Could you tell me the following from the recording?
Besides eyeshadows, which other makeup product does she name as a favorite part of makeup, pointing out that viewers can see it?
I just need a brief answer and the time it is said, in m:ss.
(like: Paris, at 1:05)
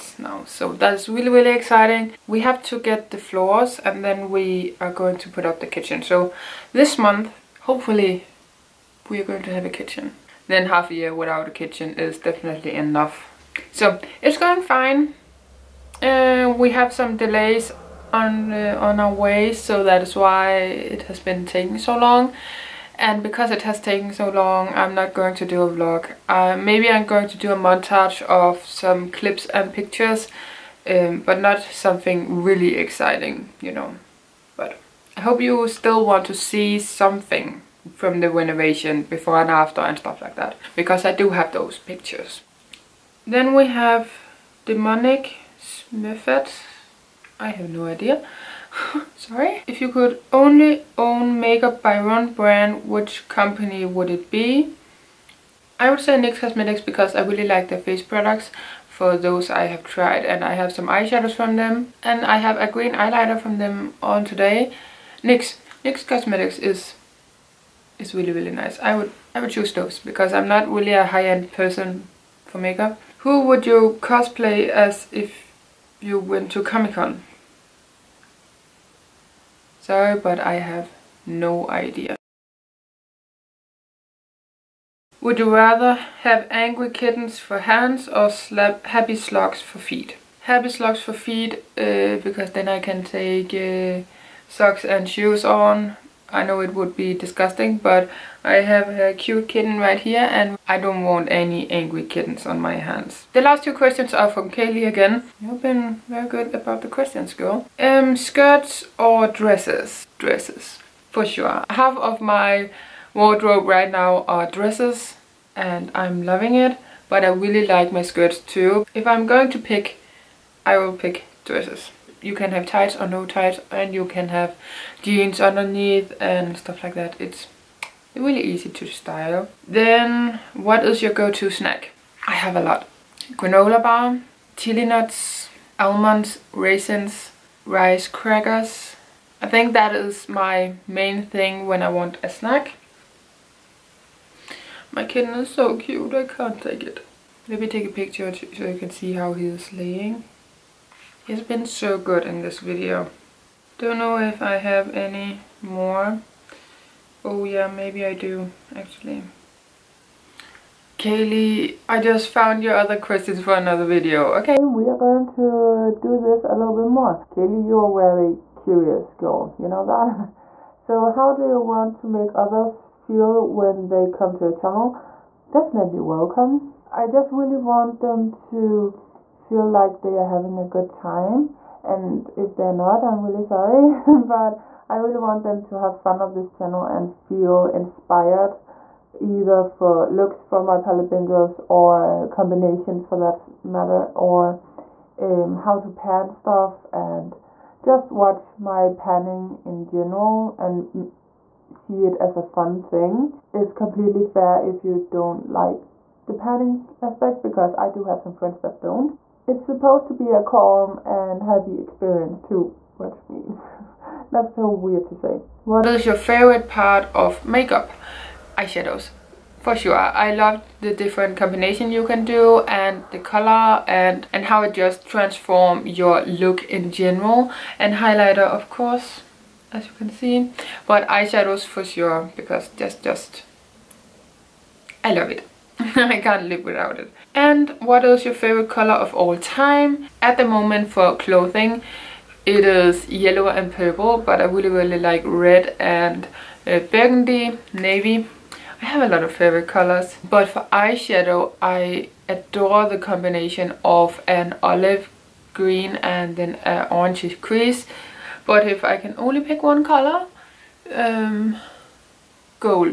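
highlighter, at 3:47.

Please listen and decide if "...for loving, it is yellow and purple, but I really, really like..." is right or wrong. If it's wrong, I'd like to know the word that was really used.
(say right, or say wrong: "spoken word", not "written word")
wrong: "clothing", not "loving".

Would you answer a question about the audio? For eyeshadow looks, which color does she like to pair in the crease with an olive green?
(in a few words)
orange.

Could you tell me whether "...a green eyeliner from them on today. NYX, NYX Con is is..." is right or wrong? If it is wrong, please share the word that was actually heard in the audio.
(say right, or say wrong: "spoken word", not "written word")
wrong: "Cosmetics", not "Con".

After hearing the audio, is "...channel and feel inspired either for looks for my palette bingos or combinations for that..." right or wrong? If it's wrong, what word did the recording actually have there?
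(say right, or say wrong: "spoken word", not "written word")
right.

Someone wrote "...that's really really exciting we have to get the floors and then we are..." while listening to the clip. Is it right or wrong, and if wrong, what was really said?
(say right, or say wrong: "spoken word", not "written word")
right.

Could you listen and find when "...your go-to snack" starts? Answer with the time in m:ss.
2:11.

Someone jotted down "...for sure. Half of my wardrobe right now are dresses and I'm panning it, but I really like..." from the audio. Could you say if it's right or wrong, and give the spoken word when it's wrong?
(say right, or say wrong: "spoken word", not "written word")
wrong: "loving", not "panning".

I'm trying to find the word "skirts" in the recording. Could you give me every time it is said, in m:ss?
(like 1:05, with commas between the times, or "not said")
1:48, 1:58.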